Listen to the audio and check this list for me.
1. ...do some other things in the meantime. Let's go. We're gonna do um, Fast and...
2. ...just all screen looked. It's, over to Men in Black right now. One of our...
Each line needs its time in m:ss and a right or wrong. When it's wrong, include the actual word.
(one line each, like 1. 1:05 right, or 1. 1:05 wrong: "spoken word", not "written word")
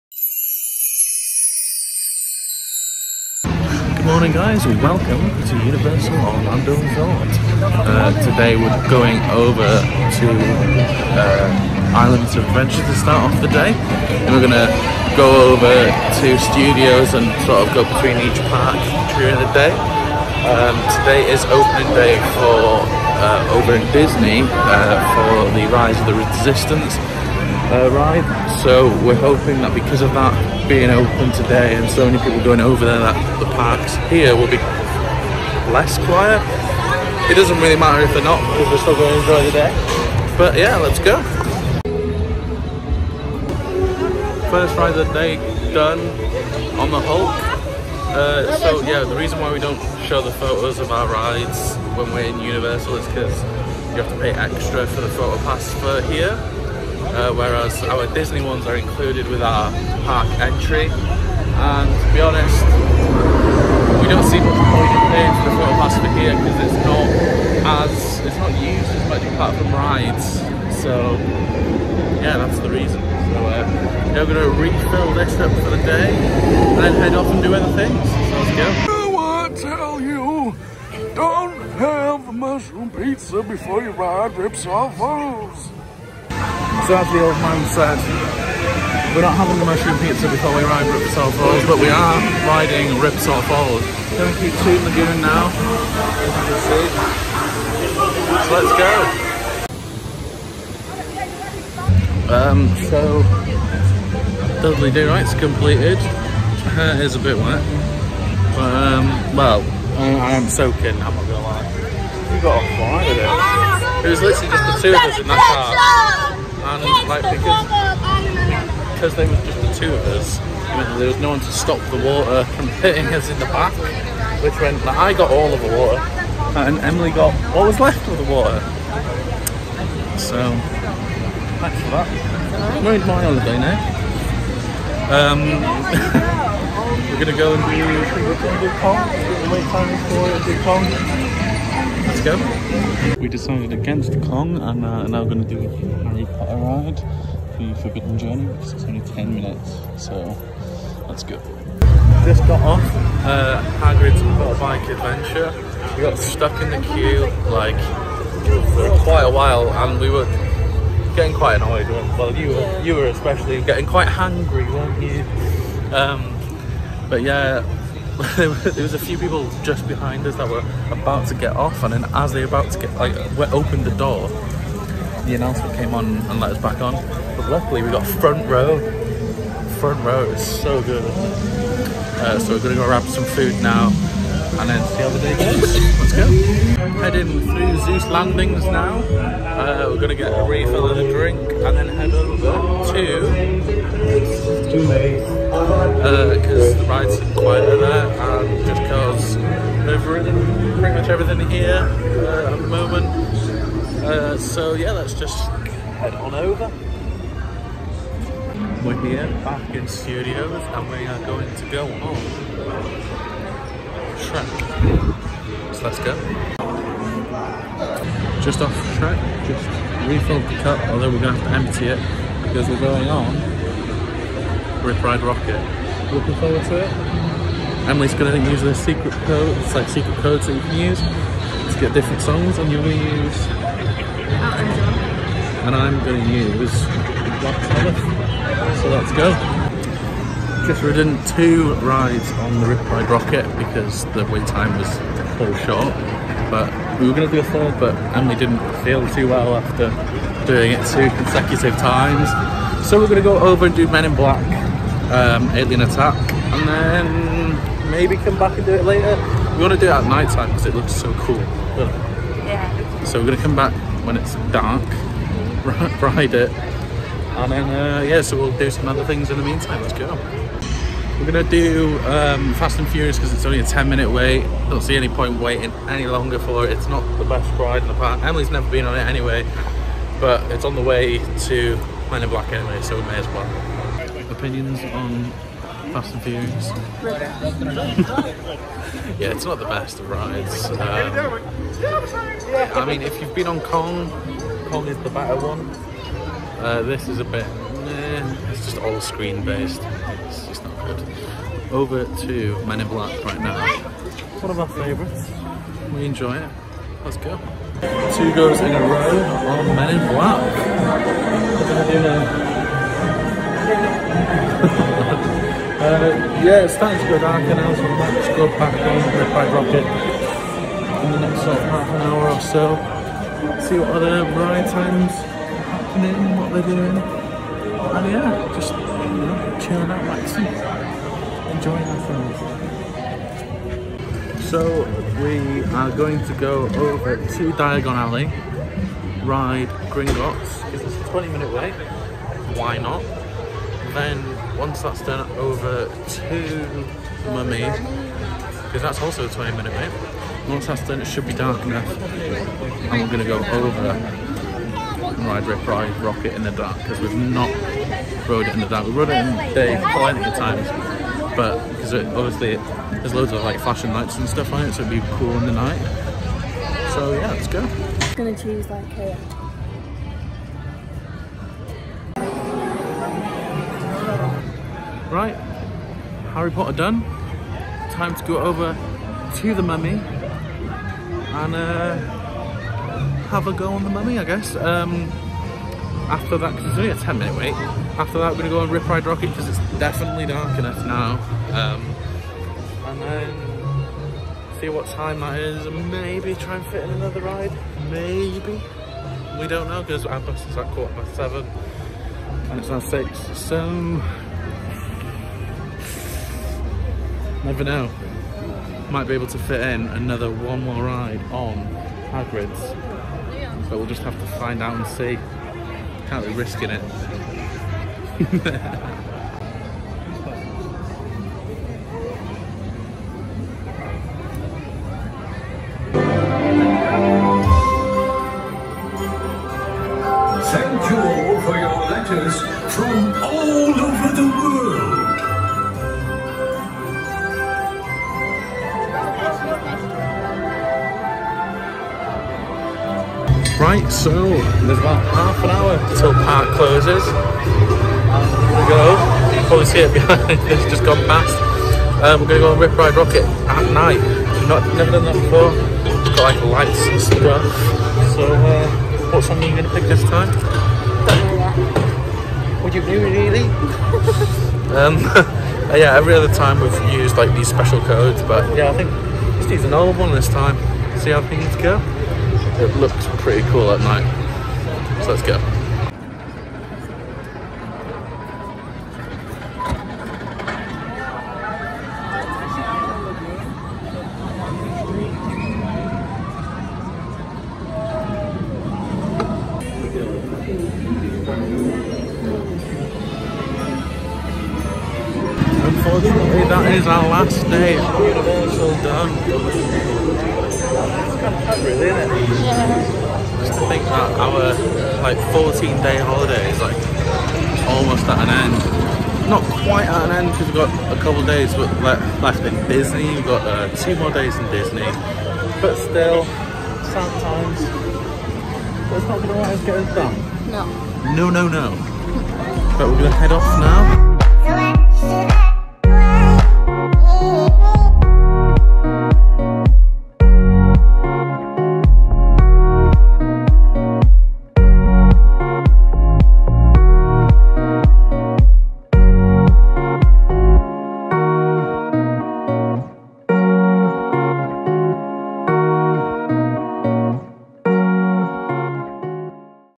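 1. 4:28 right
2. 4:58 wrong: "based", not "looked".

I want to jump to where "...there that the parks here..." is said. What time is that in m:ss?
0:32.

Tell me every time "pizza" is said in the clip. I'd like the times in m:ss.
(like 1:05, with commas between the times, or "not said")
1:22, 1:29.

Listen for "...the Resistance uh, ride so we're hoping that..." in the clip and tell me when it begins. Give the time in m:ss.
0:26.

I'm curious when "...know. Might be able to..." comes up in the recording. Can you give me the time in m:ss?
6:47.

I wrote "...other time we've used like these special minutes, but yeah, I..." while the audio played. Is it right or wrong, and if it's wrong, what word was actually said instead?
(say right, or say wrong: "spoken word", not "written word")
wrong: "codes", not "minutes".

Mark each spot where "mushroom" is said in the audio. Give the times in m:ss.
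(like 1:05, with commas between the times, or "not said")
1:22, 1:29.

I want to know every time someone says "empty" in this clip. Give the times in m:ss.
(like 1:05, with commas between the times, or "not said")
3:41.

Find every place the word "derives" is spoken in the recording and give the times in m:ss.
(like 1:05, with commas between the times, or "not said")
not said.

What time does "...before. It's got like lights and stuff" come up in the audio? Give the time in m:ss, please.
7:35.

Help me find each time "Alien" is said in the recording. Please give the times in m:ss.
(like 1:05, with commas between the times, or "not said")
4:15.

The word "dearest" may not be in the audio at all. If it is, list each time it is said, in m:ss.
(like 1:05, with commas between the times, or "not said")
not said.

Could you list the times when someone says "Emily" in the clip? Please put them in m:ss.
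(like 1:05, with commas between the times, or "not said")
2:06, 3:47, 4:08, 4:38.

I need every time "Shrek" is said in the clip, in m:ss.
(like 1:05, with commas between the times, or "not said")
3:34, 3:38.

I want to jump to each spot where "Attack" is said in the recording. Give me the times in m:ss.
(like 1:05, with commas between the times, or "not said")
4:15.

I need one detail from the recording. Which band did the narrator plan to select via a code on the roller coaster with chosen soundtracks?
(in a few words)
Black Sabbath.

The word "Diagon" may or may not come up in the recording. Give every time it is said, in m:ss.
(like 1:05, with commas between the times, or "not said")
5:37.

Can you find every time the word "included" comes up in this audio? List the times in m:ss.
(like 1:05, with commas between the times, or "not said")
0:58.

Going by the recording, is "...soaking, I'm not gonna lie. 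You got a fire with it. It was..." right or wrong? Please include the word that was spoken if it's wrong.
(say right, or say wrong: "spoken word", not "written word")
right.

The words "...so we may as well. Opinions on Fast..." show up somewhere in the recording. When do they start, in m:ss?
4:42.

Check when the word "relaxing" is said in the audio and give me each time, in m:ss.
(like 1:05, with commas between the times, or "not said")
5:30.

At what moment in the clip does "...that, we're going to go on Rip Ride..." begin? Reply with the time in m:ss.
6:28.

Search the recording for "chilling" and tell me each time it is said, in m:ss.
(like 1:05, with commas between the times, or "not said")
5:29.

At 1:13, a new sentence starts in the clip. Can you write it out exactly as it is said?
So uh, now we're gonna refill this up for the day and then head off and do other things.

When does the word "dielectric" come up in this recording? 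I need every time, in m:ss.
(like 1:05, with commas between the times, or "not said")
not said.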